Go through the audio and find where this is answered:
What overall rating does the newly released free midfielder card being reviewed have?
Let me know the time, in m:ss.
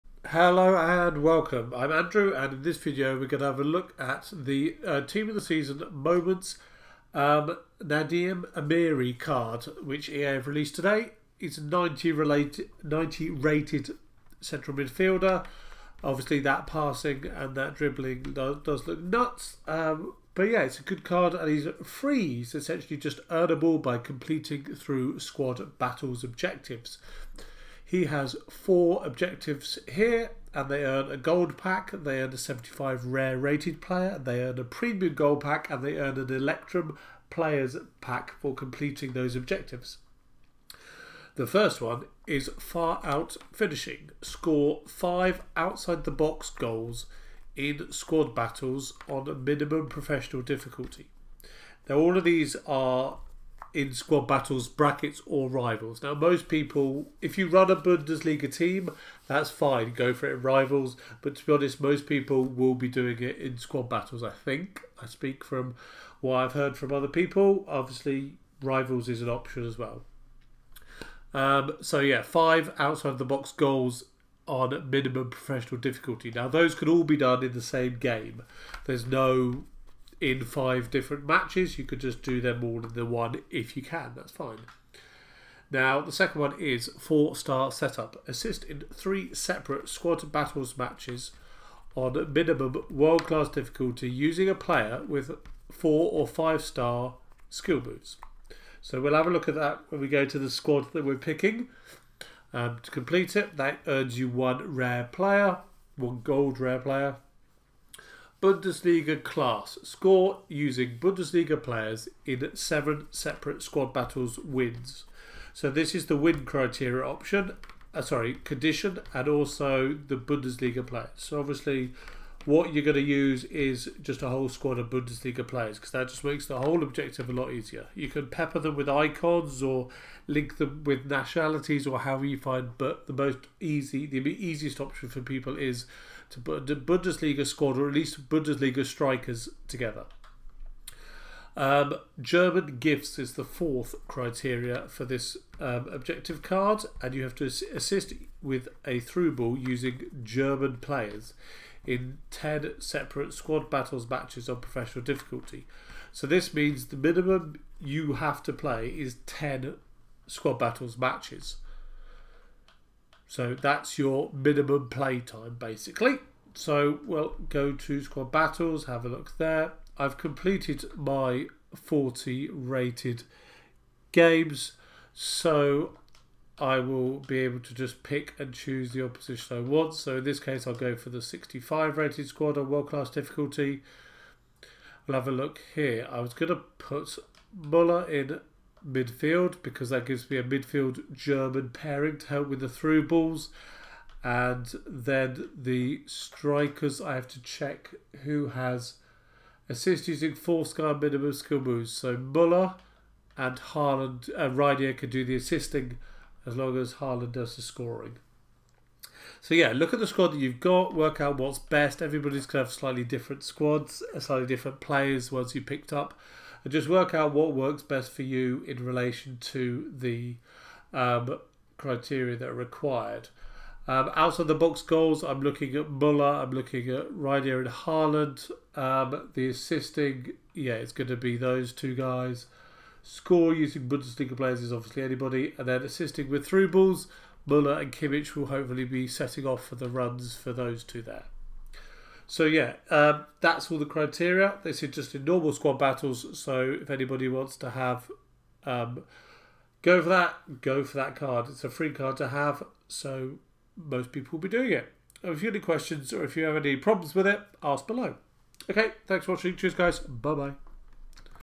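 0:12.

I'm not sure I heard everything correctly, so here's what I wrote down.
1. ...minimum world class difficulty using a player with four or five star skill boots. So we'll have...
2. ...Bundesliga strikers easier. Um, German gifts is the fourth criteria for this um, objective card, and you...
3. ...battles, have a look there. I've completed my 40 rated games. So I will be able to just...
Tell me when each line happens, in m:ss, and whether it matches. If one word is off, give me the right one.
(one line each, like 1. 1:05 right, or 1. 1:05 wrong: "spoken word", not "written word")
1. 1:32 right
2. 2:18 wrong: "together", not "easier"
3. 2:48 right.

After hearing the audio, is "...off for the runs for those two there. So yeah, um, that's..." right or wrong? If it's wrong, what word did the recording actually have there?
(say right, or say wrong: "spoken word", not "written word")
right.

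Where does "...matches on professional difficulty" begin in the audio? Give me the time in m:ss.
2:34.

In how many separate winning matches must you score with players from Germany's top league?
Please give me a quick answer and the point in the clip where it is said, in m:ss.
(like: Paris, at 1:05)
7, at 1:52.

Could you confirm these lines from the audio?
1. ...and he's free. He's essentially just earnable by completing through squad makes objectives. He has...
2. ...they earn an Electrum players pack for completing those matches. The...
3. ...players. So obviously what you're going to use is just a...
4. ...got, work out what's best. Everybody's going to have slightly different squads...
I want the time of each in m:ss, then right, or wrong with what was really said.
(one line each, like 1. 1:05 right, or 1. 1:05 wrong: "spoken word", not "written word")
1. 0:21 wrong: "battles", not "makes"
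2. 0:35 wrong: "objectives", not "matches"
3. 2:00 right
4. 3:30 right.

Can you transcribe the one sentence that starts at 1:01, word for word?
But to be honest, most people will be doing it in squad battles, I think.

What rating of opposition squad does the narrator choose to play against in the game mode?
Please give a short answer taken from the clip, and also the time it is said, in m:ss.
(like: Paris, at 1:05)
65, at 3:01.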